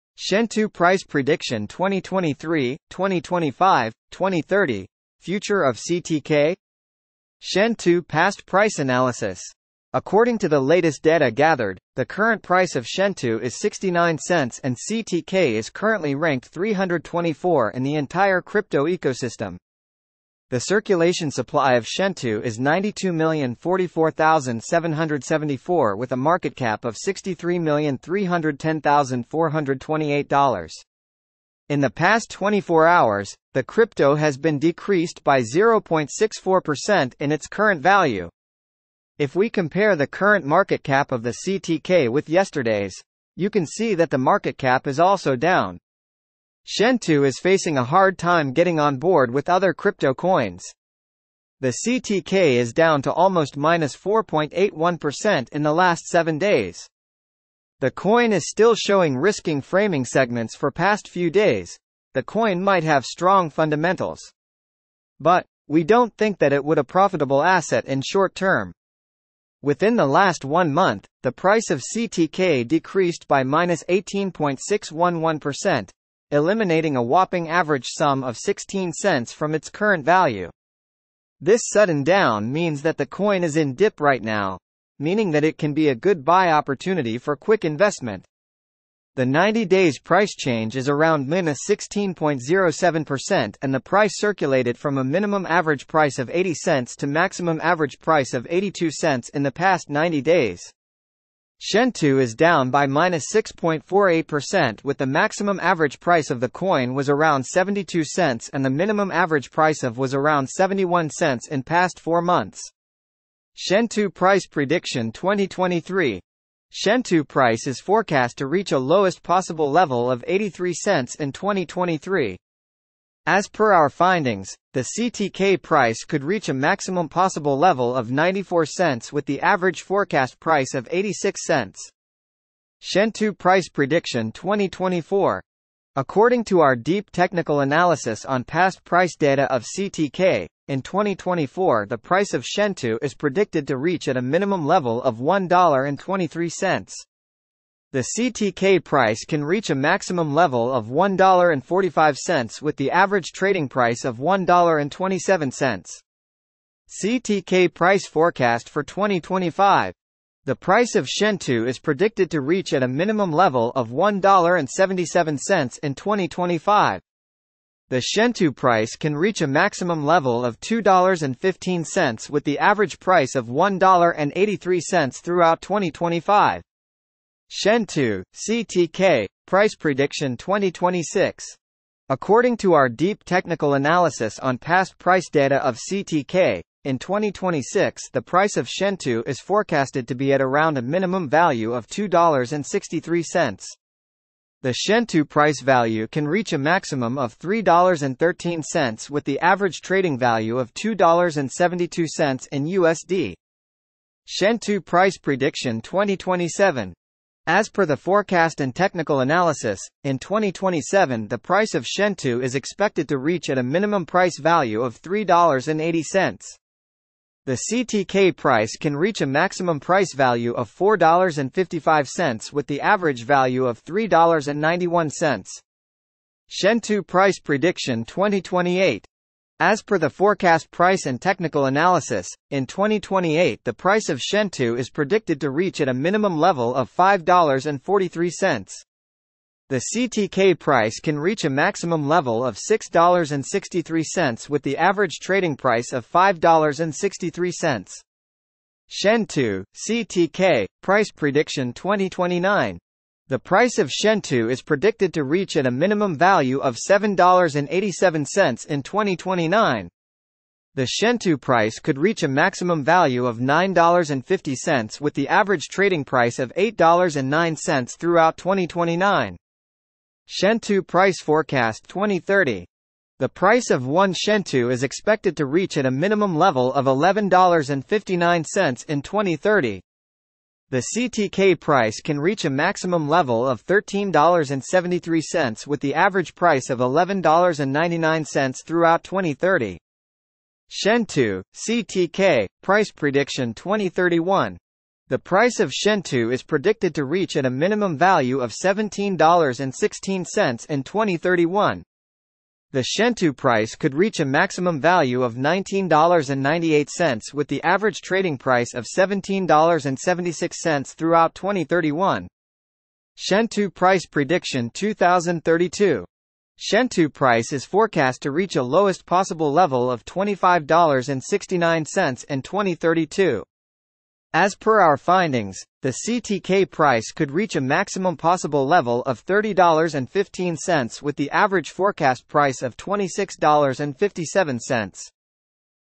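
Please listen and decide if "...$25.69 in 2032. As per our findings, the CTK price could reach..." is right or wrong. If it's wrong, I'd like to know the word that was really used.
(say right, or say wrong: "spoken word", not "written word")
right.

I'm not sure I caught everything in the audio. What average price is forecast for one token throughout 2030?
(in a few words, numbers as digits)
$11.99.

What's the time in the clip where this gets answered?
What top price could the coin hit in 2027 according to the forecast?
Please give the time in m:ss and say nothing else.
3:40.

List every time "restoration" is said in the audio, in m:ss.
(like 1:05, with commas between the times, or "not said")
not said.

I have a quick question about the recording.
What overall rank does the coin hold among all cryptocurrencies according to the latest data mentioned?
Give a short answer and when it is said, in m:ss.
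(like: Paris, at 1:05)
324, at 0:16.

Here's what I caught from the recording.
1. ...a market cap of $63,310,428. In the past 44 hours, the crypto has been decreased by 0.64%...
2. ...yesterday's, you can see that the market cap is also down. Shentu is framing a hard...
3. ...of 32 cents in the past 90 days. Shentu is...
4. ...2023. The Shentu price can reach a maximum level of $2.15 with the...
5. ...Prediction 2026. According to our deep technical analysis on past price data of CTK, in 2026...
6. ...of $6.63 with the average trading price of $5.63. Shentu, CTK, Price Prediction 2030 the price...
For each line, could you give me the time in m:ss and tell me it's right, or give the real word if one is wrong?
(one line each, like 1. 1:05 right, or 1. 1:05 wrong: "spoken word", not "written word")
1. 0:26 wrong: "24", not "44"
2. 0:42 wrong: "facing", not "framing"
3. 1:38 wrong: "82", not "32"
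4. 2:45 wrong: "2025", not "2023"
5. 2:59 right
6. 4:02 wrong: "2029", not "2030".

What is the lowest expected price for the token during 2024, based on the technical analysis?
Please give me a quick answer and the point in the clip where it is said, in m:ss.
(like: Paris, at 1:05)
$1.23, at 2:25.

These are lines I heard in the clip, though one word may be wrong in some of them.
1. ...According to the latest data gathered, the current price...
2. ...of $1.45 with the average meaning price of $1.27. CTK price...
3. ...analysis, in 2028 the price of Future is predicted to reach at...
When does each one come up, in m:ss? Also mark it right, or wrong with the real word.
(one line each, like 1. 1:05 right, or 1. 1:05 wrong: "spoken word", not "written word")
1. 0:09 right
2. 2:30 wrong: "trading", not "meaning"
3. 3:51 wrong: "Shentu", not "Future".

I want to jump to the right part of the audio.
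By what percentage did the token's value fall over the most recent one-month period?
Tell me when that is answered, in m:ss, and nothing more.
1:13.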